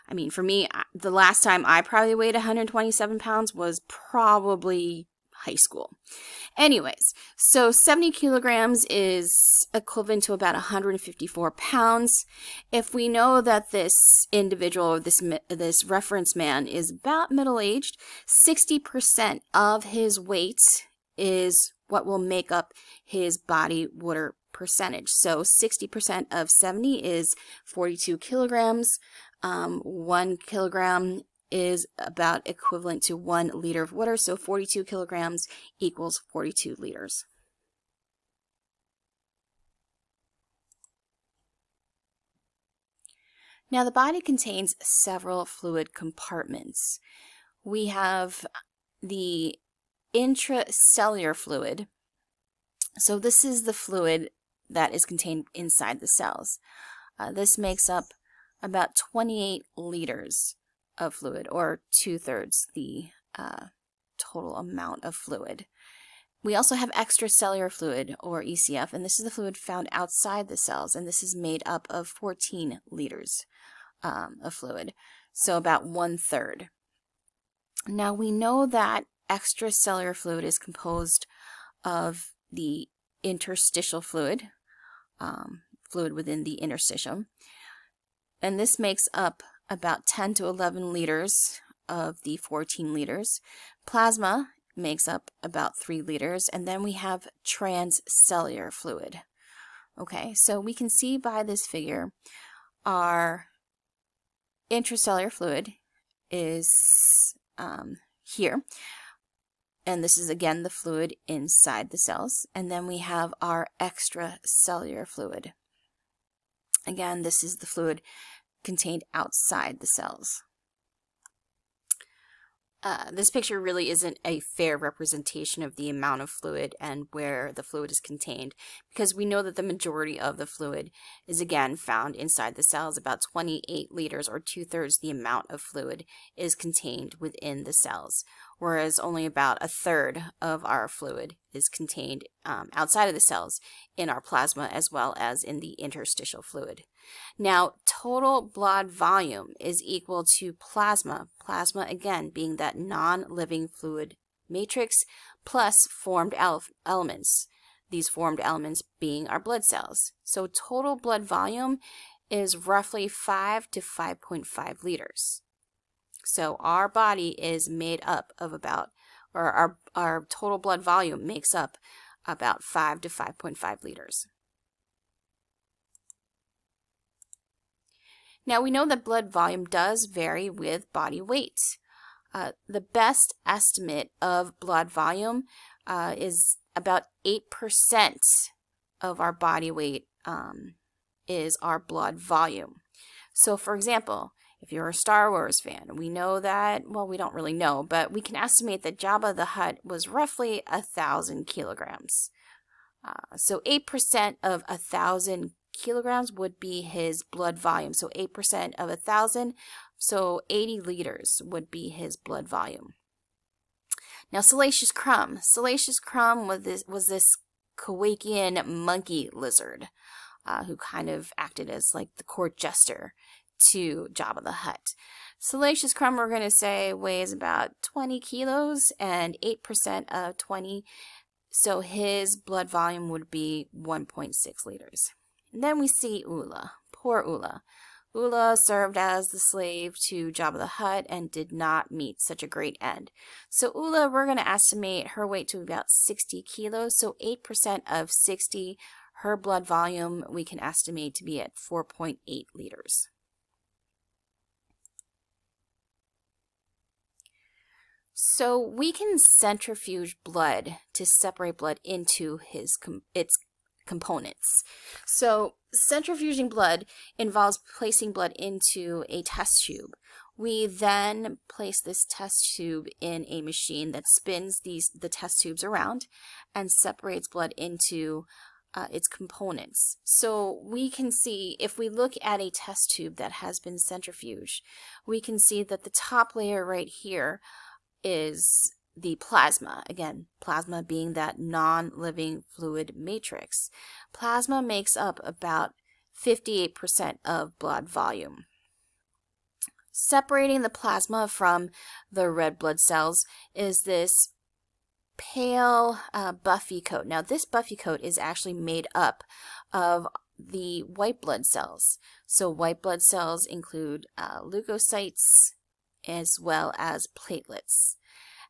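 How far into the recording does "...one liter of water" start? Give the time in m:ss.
0:33.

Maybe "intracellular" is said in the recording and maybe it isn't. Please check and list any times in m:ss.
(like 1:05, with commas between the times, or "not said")
0:50, 1:44.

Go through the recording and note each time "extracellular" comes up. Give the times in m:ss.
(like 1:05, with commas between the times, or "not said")
1:06, 1:19, 1:53.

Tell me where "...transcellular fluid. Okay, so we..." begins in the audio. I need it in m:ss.
1:37.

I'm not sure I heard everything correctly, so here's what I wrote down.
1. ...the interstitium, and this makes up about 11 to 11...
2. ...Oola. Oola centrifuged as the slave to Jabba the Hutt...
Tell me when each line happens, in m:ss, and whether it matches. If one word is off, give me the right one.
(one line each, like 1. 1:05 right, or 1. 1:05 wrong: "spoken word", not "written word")
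1. 1:26 wrong: "10", not "11"
2. 3:57 wrong: "served", not "centrifuged".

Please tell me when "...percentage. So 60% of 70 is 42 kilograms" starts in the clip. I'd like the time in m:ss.
0:24.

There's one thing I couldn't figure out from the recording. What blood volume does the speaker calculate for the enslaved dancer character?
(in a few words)
4.8 liters.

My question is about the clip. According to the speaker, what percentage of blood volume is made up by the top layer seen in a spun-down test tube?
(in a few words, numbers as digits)
58%.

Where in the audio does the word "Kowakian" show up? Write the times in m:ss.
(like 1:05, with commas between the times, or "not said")
3:37.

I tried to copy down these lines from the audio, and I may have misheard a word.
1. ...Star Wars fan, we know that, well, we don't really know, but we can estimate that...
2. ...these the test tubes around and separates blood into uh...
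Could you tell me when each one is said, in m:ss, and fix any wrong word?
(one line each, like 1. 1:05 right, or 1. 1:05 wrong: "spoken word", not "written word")
1. 3:14 right
2. 4:34 right.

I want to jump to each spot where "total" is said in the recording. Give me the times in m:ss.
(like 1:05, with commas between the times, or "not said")
1:04, 2:27, 2:40, 2:50.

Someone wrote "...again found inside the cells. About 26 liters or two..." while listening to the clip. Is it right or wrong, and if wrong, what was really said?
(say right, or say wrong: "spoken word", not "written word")
wrong: "28", not "26".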